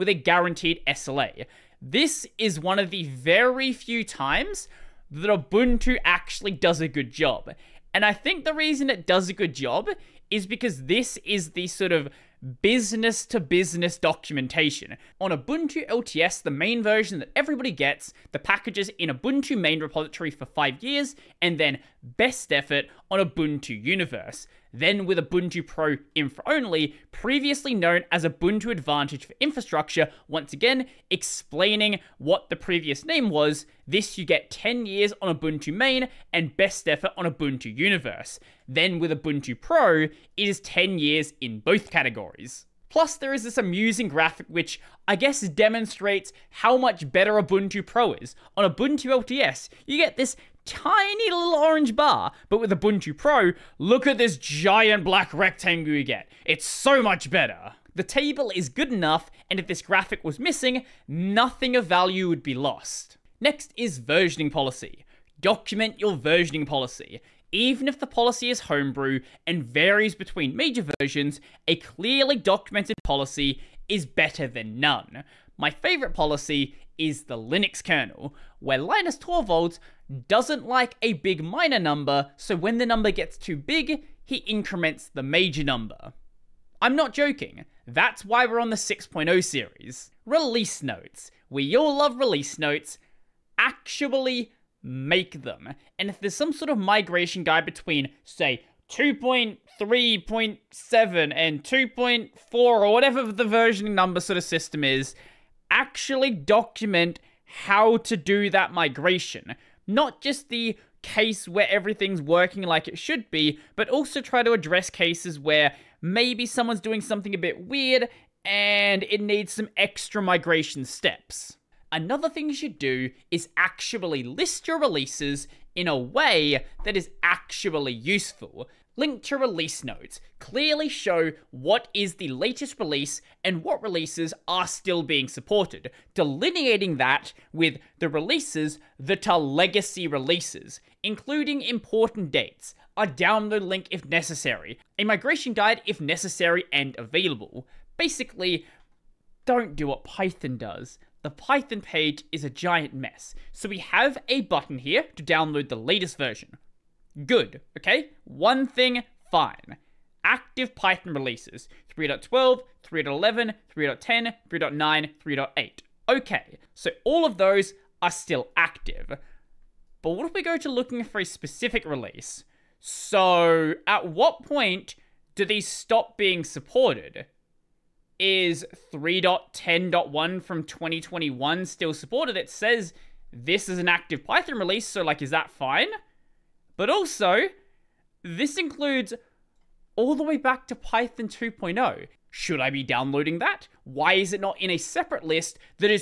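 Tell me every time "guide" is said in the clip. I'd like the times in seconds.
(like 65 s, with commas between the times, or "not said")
97 s, 145 s.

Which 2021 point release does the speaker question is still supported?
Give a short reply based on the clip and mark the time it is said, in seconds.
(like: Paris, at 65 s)
3.10.1, at 178 s.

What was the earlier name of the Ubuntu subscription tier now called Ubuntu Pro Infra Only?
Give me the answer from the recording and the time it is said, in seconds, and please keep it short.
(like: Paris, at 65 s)
Ubuntu Advantage for Infrastructure, at 28 s.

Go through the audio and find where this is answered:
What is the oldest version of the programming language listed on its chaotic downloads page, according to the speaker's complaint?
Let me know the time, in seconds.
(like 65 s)
190 s.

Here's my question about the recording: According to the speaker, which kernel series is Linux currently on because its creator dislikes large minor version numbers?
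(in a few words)
6.0.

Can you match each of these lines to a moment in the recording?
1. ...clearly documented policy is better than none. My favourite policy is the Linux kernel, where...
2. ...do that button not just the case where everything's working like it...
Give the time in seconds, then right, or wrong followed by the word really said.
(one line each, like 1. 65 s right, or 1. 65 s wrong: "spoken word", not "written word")
1. 71 s right
2. 108 s wrong: "migration", not "button".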